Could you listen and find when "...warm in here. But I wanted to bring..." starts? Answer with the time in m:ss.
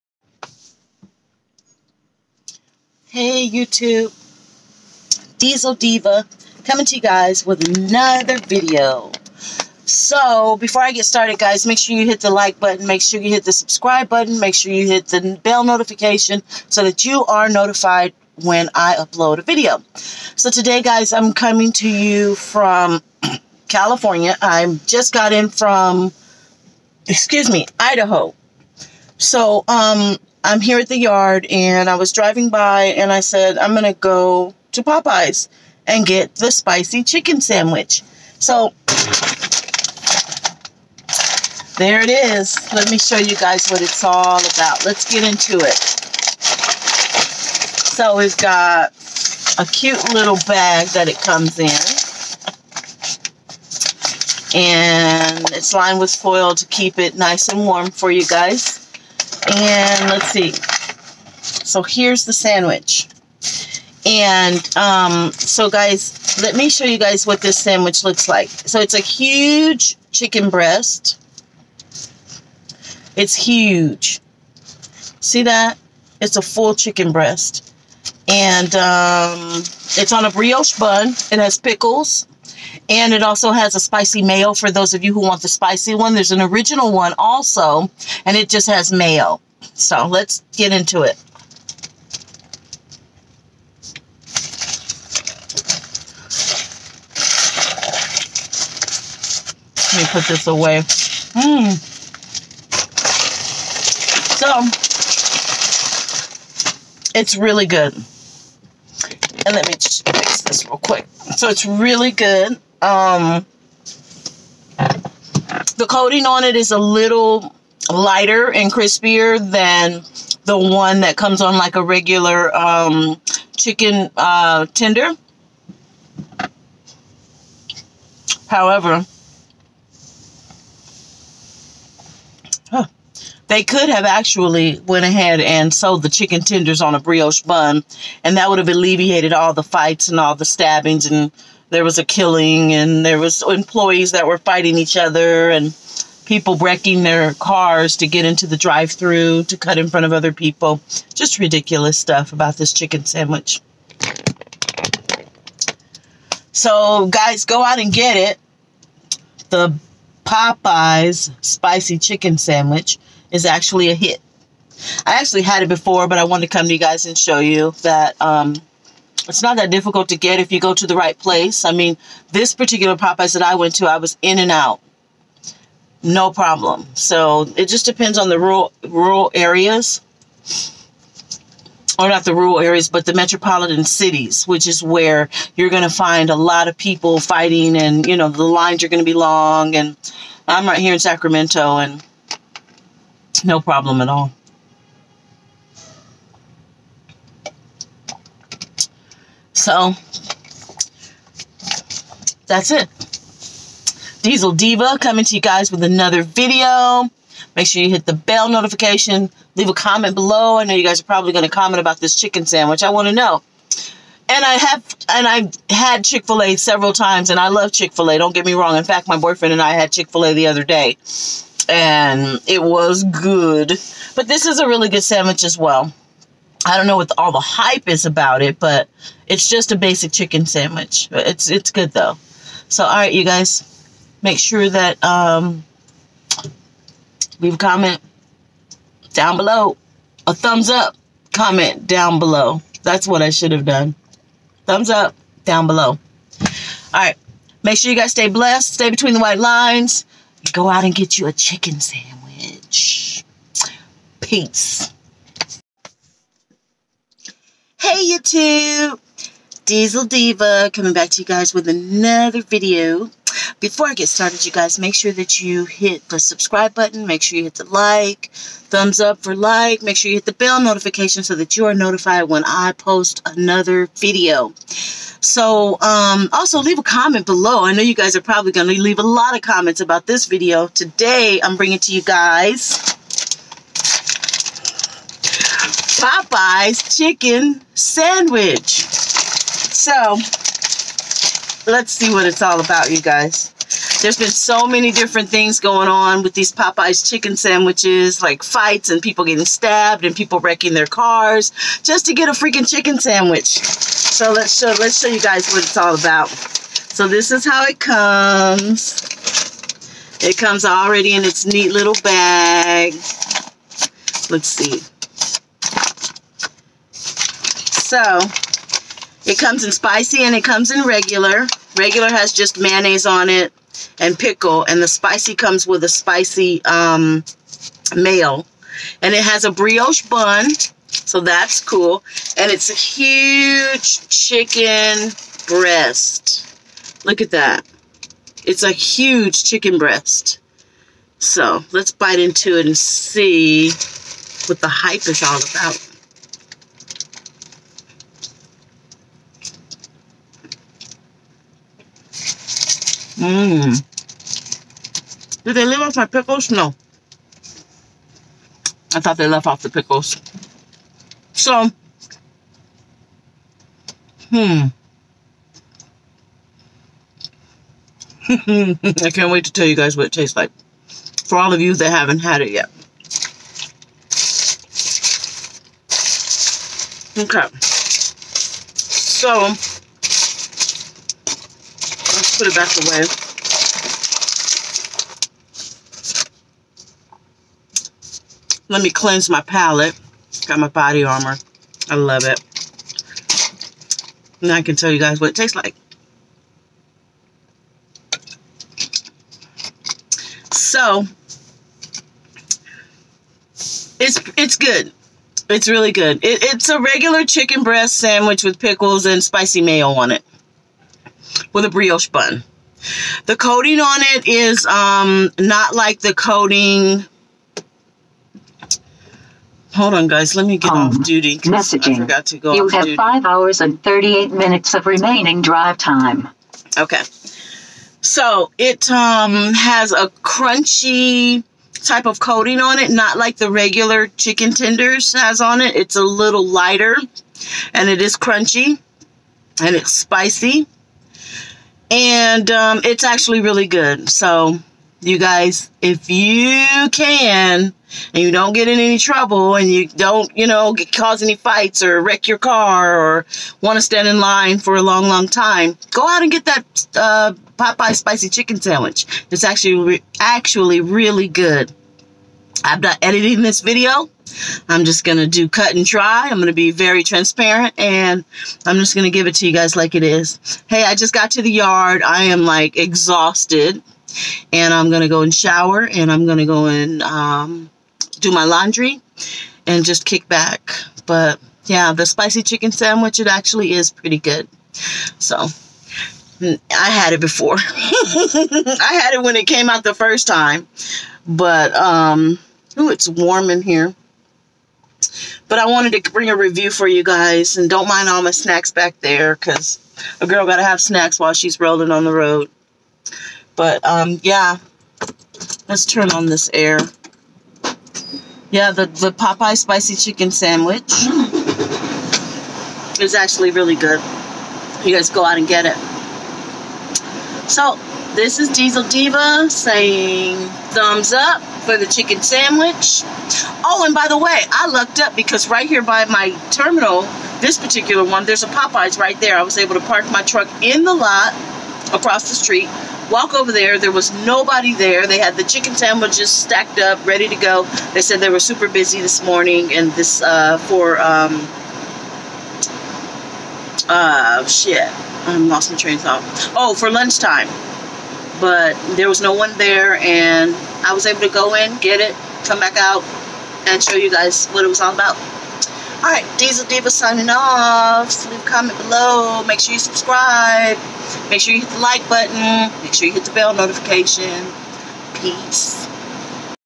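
8:13.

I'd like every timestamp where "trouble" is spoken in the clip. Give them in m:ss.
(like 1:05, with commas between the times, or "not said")
7:28.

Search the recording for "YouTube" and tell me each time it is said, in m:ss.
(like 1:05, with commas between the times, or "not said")
0:03, 4:18.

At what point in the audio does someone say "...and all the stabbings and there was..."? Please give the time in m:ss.
2:20.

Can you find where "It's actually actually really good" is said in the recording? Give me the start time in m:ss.
7:39.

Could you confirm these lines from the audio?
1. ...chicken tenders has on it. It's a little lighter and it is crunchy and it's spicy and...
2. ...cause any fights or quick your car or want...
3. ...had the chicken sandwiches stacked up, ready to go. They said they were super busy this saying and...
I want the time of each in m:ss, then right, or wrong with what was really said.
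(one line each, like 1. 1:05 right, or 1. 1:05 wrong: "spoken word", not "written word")
1. 7:14 right
2. 7:30 wrong: "wreck", not "quick"
3. 8:55 wrong: "morning", not "saying".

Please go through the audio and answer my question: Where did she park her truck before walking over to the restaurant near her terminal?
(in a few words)
Lot across the street.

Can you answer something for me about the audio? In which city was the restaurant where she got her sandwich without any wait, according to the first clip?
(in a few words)
Sacramento.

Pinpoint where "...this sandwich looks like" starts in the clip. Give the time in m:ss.
1:07.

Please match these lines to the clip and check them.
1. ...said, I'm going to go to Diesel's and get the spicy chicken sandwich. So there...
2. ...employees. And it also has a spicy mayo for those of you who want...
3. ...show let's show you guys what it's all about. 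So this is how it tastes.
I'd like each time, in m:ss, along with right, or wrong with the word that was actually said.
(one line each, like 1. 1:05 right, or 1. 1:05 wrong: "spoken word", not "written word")
1. 0:33 wrong: "Popeye", not "Diesel"
2. 1:21 wrong: "pickles", not "employees"
3. 5:04 wrong: "comes", not "tastes".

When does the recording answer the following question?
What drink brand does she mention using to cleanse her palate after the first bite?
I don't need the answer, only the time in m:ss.
6:30.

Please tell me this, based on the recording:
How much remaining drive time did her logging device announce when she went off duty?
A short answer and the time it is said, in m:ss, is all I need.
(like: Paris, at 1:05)
5 hours 38 minutes, at 7:02.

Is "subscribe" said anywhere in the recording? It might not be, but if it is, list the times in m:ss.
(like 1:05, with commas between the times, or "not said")
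0:13, 4:26, 9:19.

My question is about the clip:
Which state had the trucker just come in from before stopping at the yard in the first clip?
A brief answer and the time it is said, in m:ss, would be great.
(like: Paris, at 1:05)
Idaho, at 0:27.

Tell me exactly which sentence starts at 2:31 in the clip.
Just ridiculous stuff about this chicken sandwich.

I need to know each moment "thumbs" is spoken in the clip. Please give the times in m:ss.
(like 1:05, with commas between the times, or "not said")
4:00, 4:04, 4:28, 8:40.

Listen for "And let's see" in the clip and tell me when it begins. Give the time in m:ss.
0:59.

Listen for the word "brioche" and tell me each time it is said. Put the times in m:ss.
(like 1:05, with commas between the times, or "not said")
1:20, 2:16, 5:29, 6:51.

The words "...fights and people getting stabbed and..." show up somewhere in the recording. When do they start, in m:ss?
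4:58.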